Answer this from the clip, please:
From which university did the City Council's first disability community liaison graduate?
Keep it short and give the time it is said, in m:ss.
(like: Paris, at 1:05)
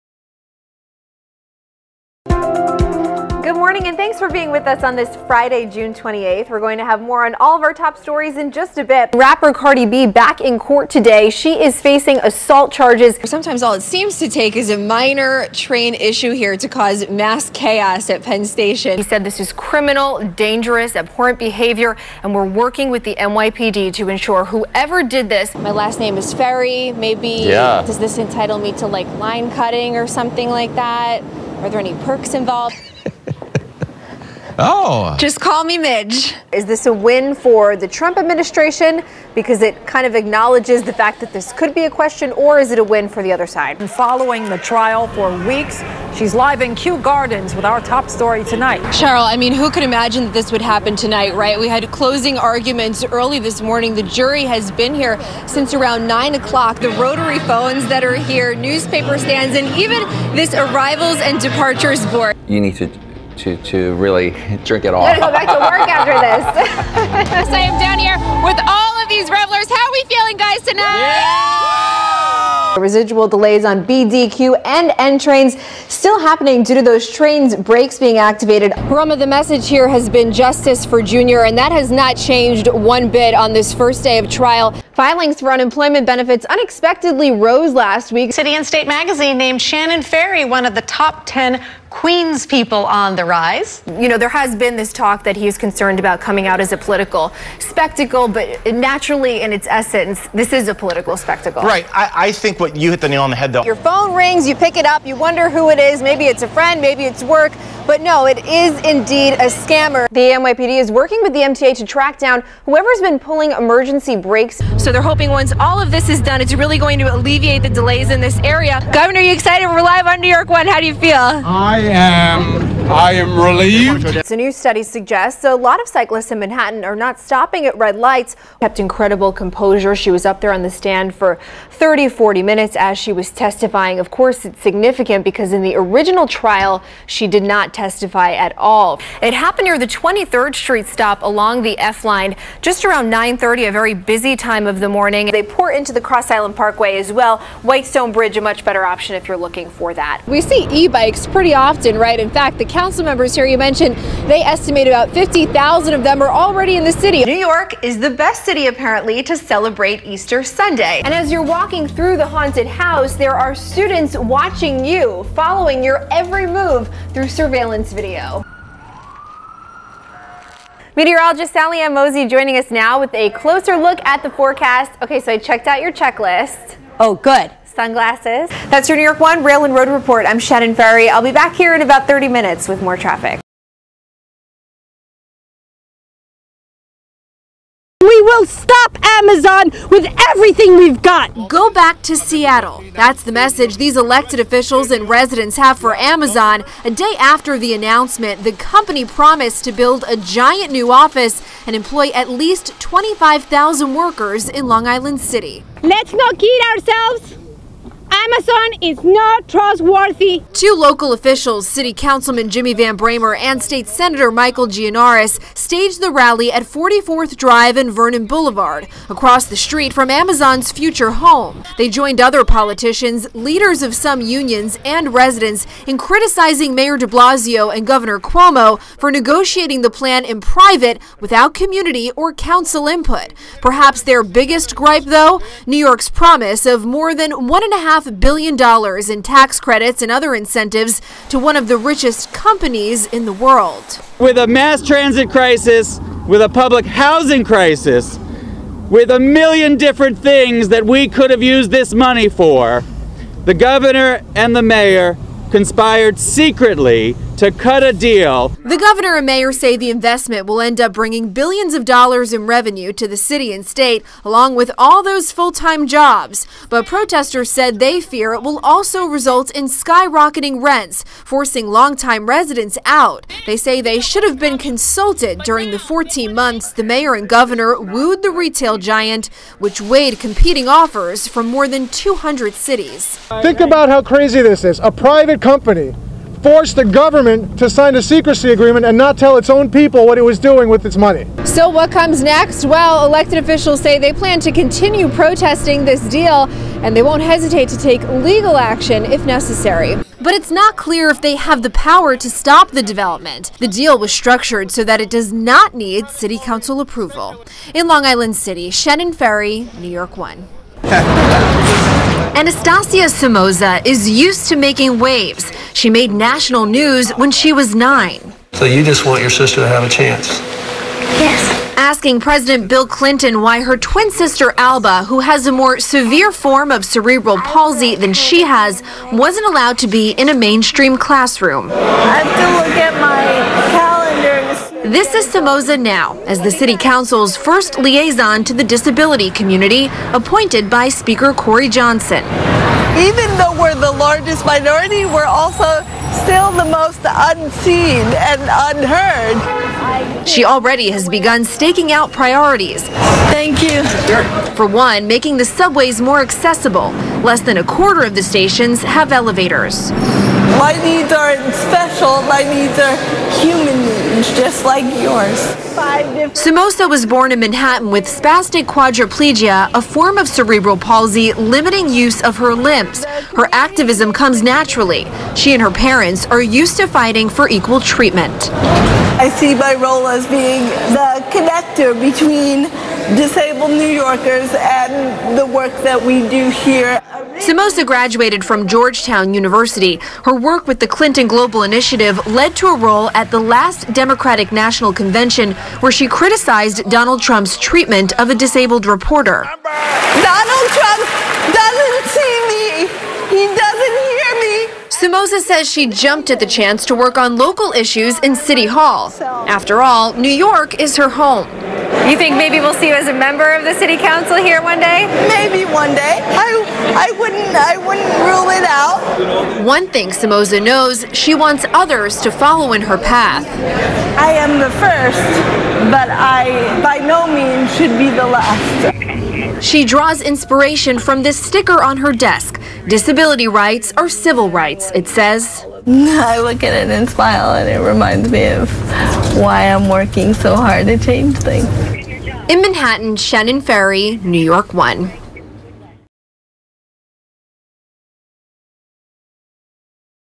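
Georgetown University, at 6:28.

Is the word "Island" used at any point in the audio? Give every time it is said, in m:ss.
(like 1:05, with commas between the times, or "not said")
2:26, 3:24, 5:08.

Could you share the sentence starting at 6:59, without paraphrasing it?
One thing Somoza knows, she wants others to follow in her path.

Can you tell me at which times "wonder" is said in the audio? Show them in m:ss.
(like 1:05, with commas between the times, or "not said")
1:45.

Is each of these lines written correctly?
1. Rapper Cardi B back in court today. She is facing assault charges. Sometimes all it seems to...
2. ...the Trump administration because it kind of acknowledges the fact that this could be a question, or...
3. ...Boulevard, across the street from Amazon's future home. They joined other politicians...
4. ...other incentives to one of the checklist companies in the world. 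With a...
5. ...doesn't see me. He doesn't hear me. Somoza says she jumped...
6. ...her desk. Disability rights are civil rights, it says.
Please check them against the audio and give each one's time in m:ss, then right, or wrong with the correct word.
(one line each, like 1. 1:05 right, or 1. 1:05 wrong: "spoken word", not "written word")
1. 0:09 right
2. 0:37 right
3. 3:38 right
4. 4:00 wrong: "richest", not "checklist"
5. 6:41 right
6. 7:11 right.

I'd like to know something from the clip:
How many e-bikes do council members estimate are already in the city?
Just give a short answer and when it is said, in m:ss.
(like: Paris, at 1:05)
50,000, at 2:35.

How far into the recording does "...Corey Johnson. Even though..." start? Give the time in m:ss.
5:41.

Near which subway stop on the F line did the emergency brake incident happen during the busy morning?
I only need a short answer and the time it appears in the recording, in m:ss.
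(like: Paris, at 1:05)
23rd Street, at 2:19.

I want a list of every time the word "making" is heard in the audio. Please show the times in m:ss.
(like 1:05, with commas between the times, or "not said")
5:14, 5:55.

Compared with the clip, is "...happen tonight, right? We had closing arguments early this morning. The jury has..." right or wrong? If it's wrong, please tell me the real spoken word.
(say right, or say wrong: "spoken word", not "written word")
right.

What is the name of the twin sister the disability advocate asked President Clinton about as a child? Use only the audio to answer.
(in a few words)
Alba.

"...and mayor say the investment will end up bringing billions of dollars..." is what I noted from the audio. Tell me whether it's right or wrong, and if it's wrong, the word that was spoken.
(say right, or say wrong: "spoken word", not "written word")
right.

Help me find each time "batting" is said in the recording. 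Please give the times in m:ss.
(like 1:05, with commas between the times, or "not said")
not said.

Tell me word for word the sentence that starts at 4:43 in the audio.
Think about how crazy this is.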